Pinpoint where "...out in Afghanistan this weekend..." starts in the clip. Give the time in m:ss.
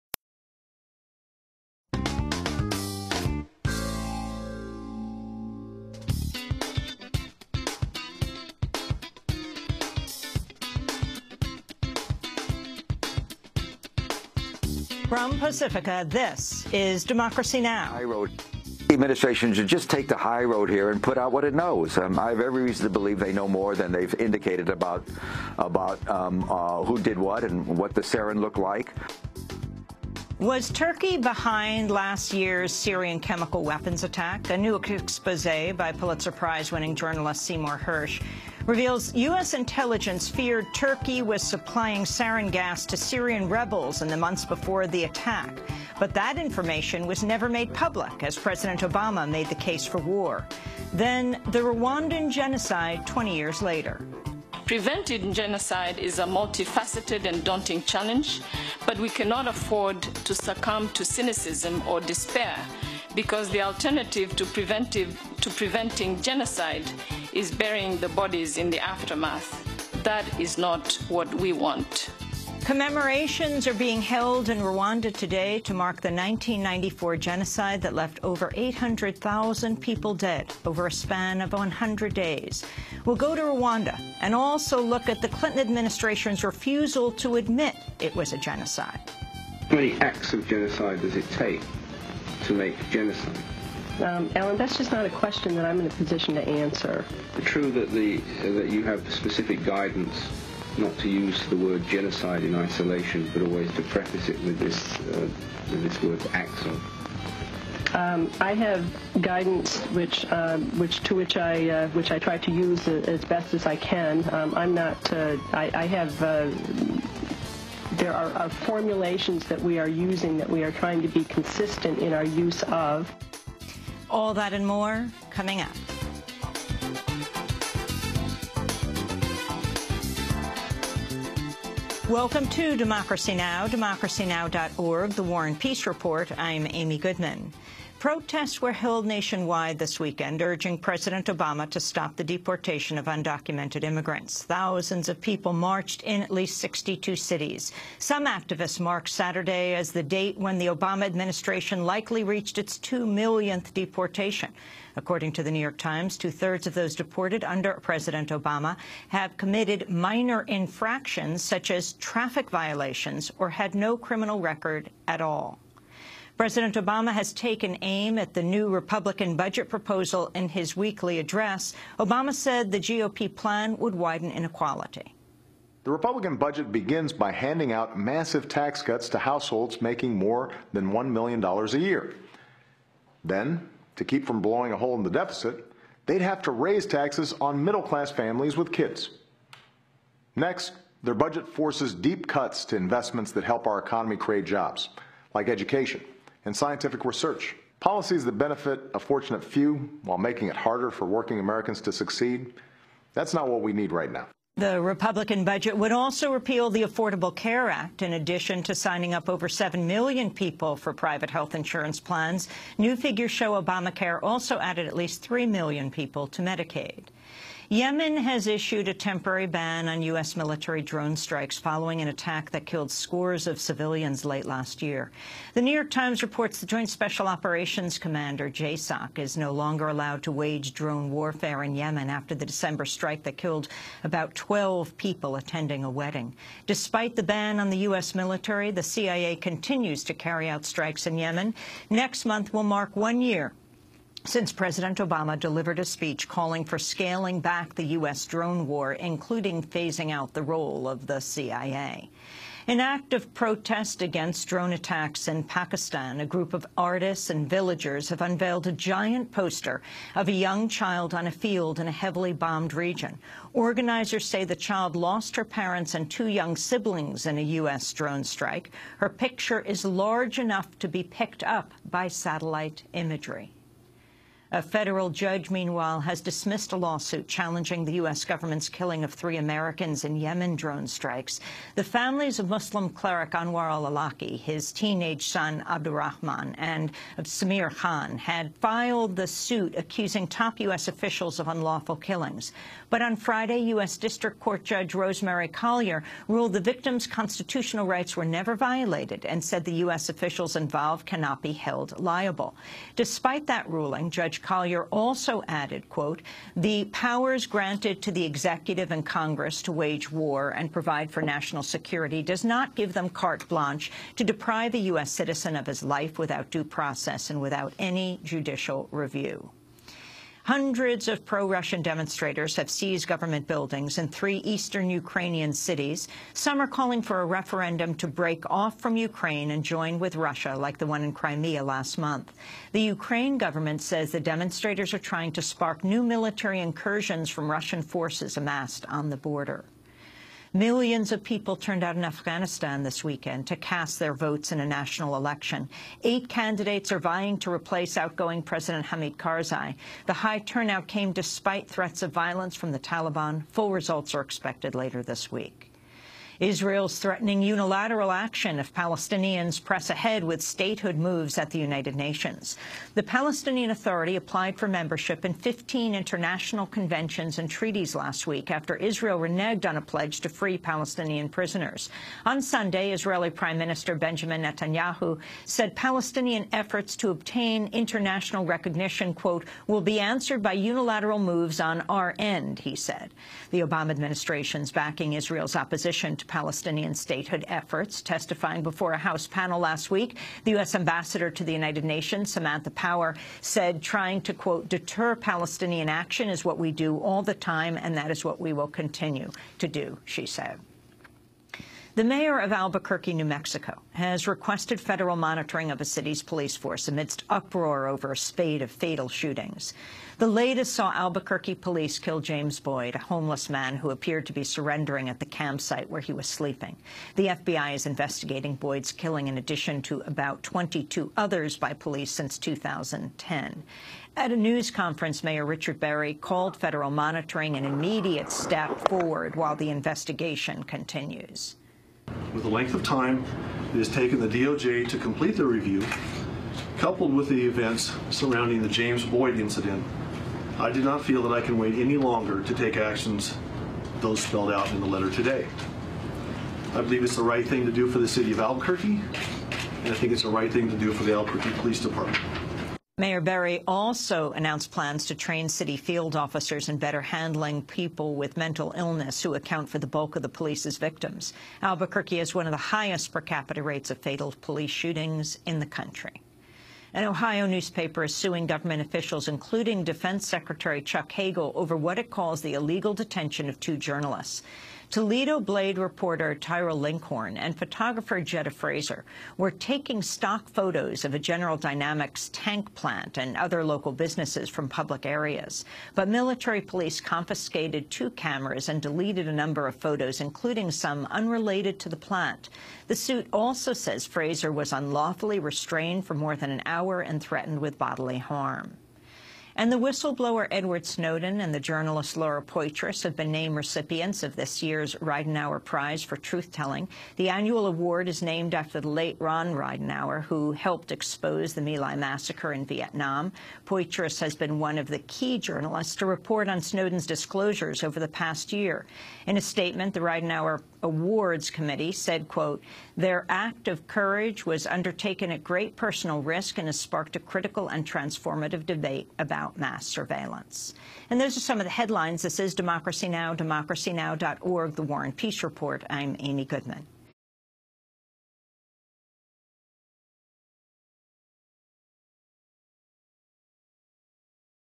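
5:41.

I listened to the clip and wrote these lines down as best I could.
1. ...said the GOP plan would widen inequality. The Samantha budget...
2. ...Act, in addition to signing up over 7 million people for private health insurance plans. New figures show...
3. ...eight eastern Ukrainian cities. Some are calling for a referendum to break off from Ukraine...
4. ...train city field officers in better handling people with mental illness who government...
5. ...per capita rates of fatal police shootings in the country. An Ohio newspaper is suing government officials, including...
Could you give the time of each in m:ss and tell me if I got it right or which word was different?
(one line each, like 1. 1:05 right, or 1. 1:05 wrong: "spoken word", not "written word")
1. 2:52 wrong: "Republican", not "Samantha"
2. 3:27 right
3. 5:24 wrong: "three", not "eight"
4. 7:35 wrong: "account", not "government"
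5. 7:43 right.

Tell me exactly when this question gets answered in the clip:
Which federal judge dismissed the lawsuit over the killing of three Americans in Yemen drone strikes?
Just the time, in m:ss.
4:54.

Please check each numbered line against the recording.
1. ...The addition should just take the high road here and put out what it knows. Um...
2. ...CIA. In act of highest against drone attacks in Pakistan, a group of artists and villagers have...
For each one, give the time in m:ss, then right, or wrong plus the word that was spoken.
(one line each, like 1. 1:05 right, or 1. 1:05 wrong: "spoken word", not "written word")
1. 0:18 wrong: "administration", not "addition"
2. 4:11 wrong: "protest", not "highest".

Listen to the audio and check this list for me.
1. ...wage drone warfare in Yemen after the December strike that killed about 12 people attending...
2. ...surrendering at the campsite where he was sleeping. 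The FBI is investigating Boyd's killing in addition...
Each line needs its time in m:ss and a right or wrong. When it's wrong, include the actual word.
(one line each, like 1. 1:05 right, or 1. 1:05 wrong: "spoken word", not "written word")
1. 3:50 right
2. 6:54 right.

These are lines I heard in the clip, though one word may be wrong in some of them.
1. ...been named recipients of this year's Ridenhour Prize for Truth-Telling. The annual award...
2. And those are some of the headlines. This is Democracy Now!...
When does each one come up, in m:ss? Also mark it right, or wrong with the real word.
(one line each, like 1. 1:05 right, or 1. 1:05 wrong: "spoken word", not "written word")
1. 8:23 right
2. 8:51 right.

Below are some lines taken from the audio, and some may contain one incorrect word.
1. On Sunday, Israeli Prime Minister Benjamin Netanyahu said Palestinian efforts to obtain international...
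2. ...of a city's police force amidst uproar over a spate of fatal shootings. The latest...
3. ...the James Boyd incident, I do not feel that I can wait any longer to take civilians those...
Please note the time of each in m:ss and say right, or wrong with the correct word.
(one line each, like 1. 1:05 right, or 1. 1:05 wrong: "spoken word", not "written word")
1. 6:12 right
2. 6:45 right
3. 7:18 wrong: "actions", not "civilians".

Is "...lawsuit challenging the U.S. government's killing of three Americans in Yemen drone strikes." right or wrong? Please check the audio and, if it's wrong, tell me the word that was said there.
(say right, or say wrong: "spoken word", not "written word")
right.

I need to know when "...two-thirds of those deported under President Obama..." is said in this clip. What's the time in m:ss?
2:36.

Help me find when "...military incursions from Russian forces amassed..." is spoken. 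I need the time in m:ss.
5:36.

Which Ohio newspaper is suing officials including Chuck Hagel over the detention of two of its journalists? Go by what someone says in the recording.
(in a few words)
Toledo Blade.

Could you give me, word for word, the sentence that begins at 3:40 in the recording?
military drone strikes following an attack that killed scores of civilians late last year.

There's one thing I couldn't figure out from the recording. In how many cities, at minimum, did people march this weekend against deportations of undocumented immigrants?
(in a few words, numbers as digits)
62.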